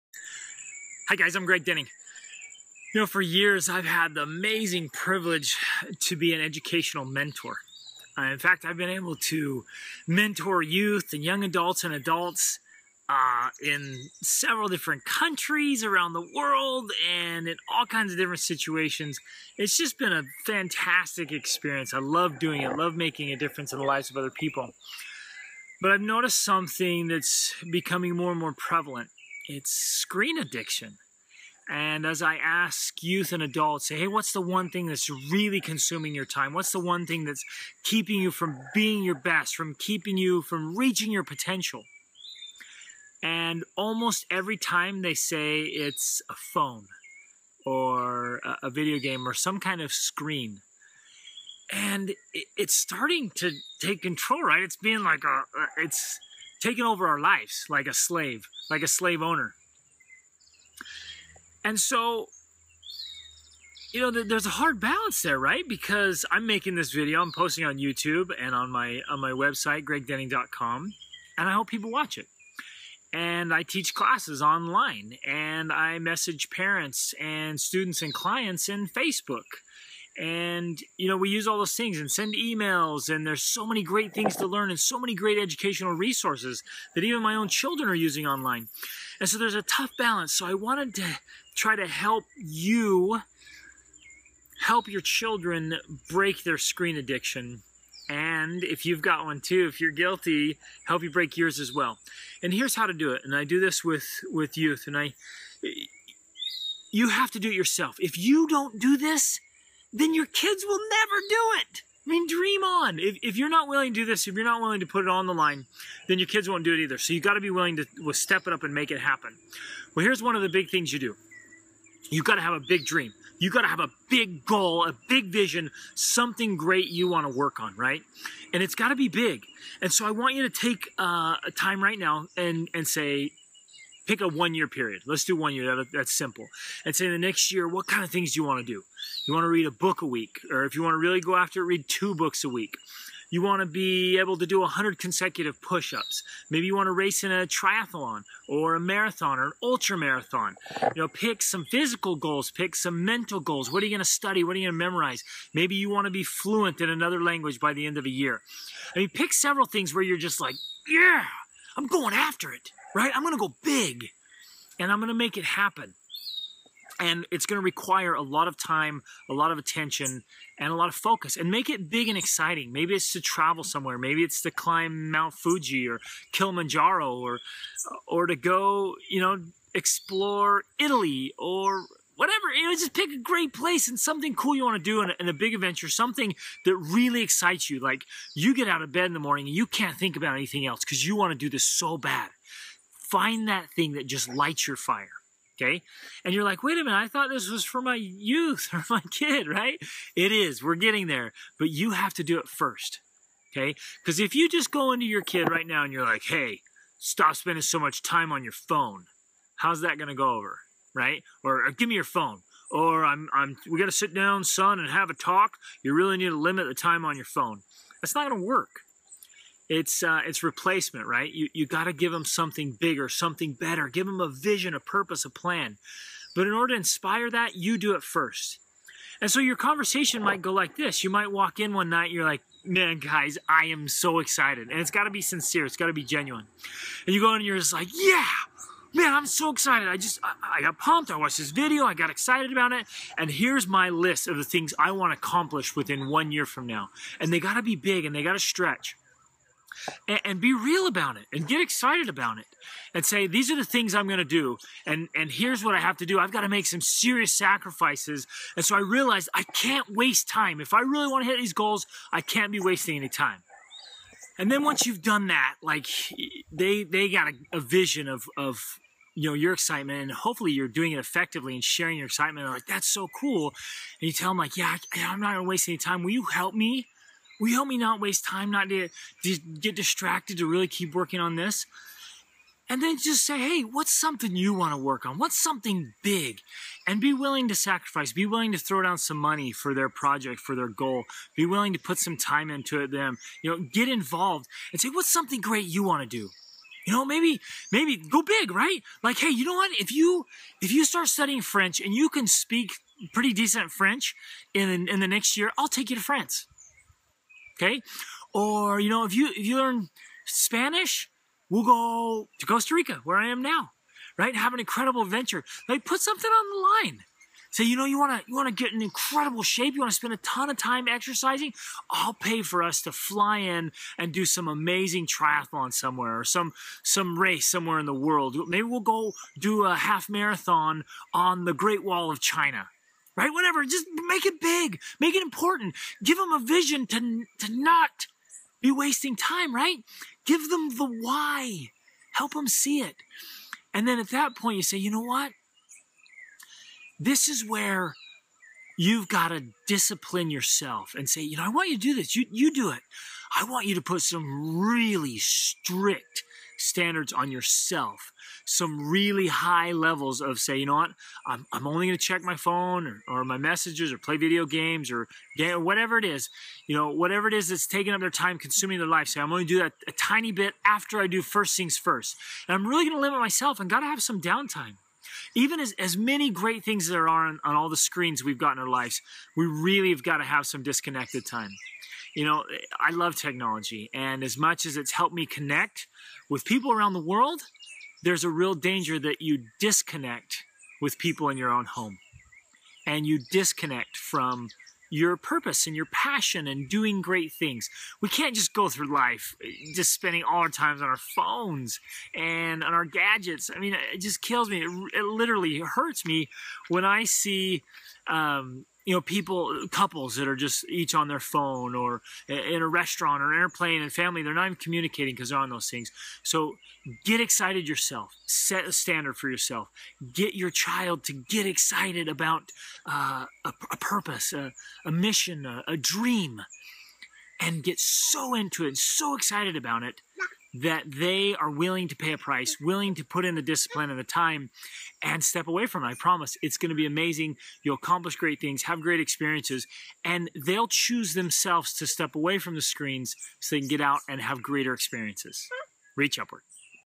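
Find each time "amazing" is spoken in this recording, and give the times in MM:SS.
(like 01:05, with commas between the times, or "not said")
00:04, 05:24, 07:16.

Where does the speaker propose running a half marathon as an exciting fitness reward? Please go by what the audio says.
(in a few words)
Great Wall of China.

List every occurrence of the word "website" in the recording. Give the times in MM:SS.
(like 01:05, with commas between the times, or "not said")
01:09.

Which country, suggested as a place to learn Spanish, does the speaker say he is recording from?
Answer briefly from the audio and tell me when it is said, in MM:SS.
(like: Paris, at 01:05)
Costa Rica, at 05:12.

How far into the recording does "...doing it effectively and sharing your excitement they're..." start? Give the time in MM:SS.
04:30.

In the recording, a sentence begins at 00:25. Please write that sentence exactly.
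But I've noticed something that's becoming more and more prevalent it's screen addiction.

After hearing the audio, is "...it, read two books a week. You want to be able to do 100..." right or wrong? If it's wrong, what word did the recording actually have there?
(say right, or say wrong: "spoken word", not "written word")
right.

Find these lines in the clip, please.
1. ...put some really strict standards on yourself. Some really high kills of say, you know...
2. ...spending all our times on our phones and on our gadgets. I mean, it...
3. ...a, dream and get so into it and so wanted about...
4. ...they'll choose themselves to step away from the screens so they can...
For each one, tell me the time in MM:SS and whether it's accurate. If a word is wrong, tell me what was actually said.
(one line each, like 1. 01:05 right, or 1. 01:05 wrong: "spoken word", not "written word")
1. 05:53 wrong: "levels", not "kills"
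2. 06:39 right
3. 07:05 wrong: "excited", not "wanted"
4. 07:20 right.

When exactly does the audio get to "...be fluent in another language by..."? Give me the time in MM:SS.
02:36.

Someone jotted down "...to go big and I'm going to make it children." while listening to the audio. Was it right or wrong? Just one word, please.
wrong.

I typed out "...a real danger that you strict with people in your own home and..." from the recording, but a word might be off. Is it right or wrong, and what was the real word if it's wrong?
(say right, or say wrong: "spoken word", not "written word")
wrong: "disconnect", not "strict".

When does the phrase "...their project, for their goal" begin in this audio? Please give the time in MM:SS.
04:49.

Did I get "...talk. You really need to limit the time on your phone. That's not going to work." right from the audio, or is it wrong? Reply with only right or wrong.
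right.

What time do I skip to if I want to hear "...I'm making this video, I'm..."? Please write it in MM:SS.
01:06.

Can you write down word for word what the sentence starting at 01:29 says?
And so there's a tough balance.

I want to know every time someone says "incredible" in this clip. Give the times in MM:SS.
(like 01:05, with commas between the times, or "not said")
05:14, 05:18.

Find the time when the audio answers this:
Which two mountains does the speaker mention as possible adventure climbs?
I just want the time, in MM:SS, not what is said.
02:55.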